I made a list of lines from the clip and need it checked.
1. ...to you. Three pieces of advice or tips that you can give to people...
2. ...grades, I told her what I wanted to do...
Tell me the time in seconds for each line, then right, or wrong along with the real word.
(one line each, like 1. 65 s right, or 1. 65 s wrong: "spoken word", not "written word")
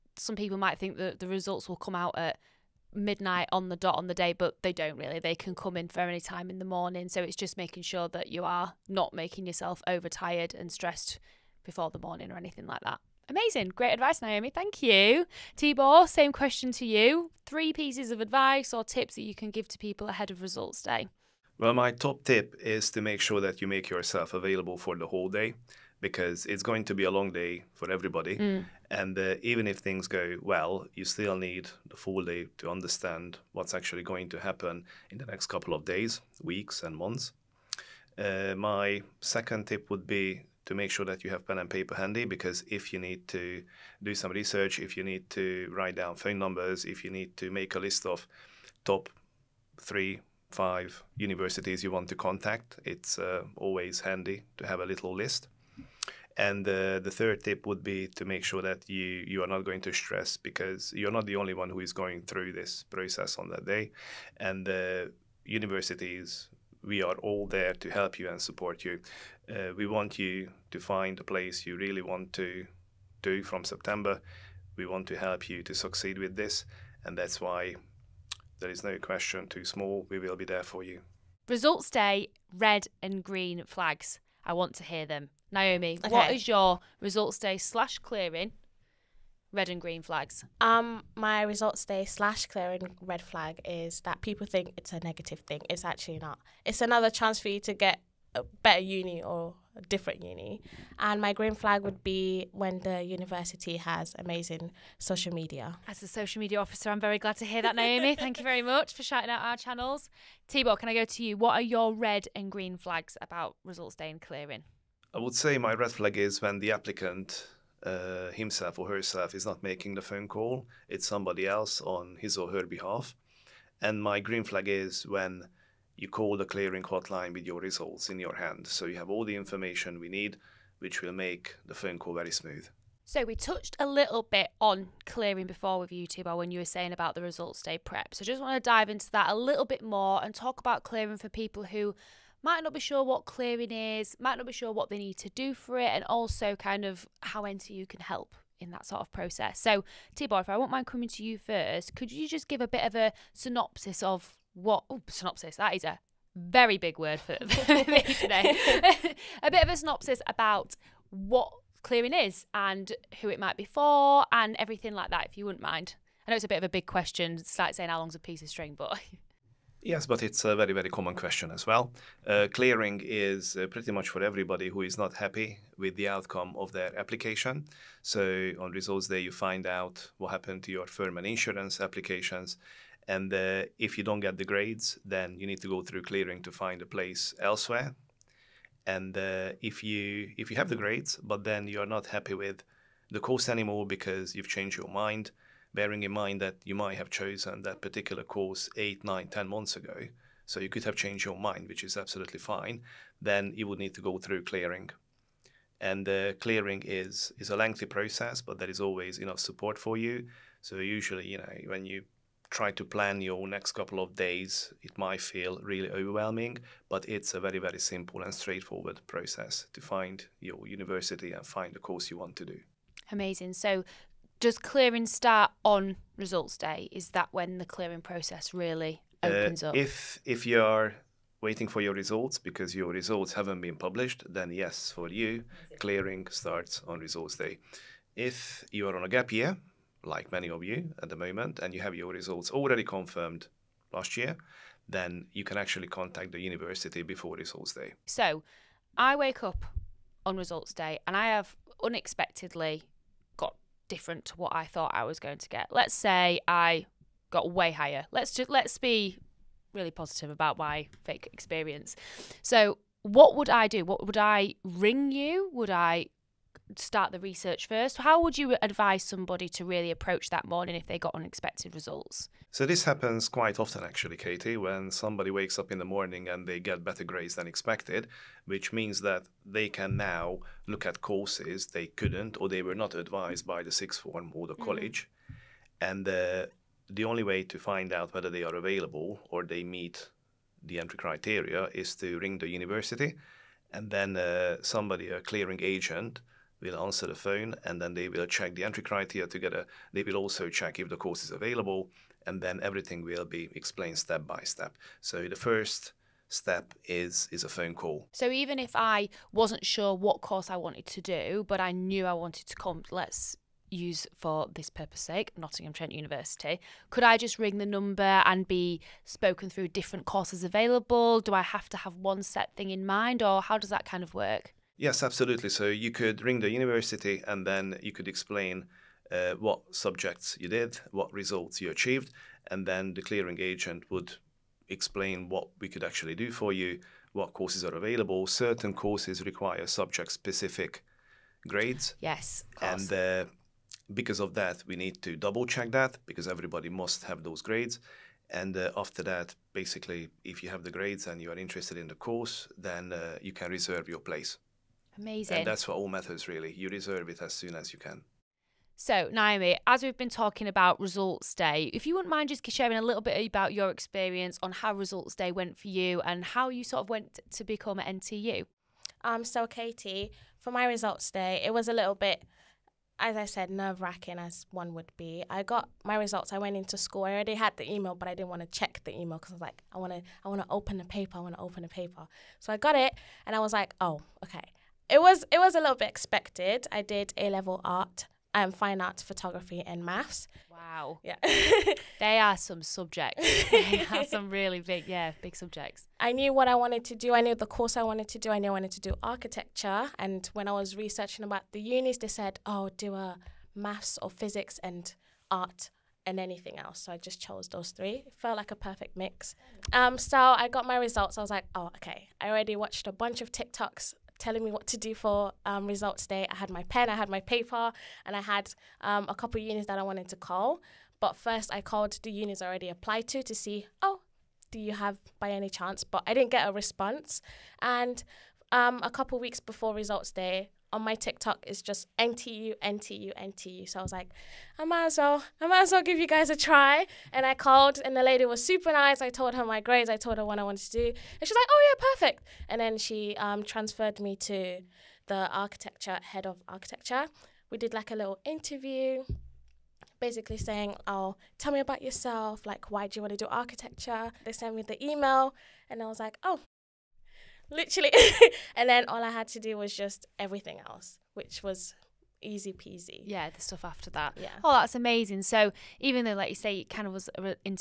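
1. 16 s right
2. 439 s right.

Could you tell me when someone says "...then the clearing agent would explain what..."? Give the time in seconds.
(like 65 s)
332 s.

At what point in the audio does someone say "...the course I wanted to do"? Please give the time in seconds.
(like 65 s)
397 s.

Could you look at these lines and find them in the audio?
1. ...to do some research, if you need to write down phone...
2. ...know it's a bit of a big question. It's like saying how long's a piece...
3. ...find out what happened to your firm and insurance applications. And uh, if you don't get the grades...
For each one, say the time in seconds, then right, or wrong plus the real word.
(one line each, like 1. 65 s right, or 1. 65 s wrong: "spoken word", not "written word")
1. 43 s right
2. 166 s right
3. 179 s right.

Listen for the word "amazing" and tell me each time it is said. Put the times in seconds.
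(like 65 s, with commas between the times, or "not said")
13 s, 104 s, 223 s, 354 s, 464 s.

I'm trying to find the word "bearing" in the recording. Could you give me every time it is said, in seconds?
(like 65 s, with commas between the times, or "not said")
195 s.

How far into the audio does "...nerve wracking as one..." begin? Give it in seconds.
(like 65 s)
373 s.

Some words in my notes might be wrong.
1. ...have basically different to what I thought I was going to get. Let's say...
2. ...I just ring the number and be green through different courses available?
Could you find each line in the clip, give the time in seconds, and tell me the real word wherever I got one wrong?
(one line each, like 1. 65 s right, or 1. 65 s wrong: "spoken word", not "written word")
1. 251 s wrong: "unexpectedly", not "basically"
2. 317 s wrong: "spoken", not "green".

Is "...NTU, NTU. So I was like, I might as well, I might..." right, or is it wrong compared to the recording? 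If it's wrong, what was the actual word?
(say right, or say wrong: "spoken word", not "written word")
right.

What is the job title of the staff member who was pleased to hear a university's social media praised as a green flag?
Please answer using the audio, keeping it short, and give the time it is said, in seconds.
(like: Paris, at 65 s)
Social media officer, at 106 s.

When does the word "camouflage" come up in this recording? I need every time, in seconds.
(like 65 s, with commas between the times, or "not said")
not said.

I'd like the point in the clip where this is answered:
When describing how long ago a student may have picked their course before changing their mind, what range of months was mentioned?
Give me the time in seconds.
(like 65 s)
198 s.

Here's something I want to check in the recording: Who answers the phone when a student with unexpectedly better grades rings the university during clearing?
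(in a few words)
A clearing agent.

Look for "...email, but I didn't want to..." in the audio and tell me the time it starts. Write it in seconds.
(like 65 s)
377 s.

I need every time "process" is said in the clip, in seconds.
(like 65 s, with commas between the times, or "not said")
62 s, 149 s, 207 s, 219 s, 228 s.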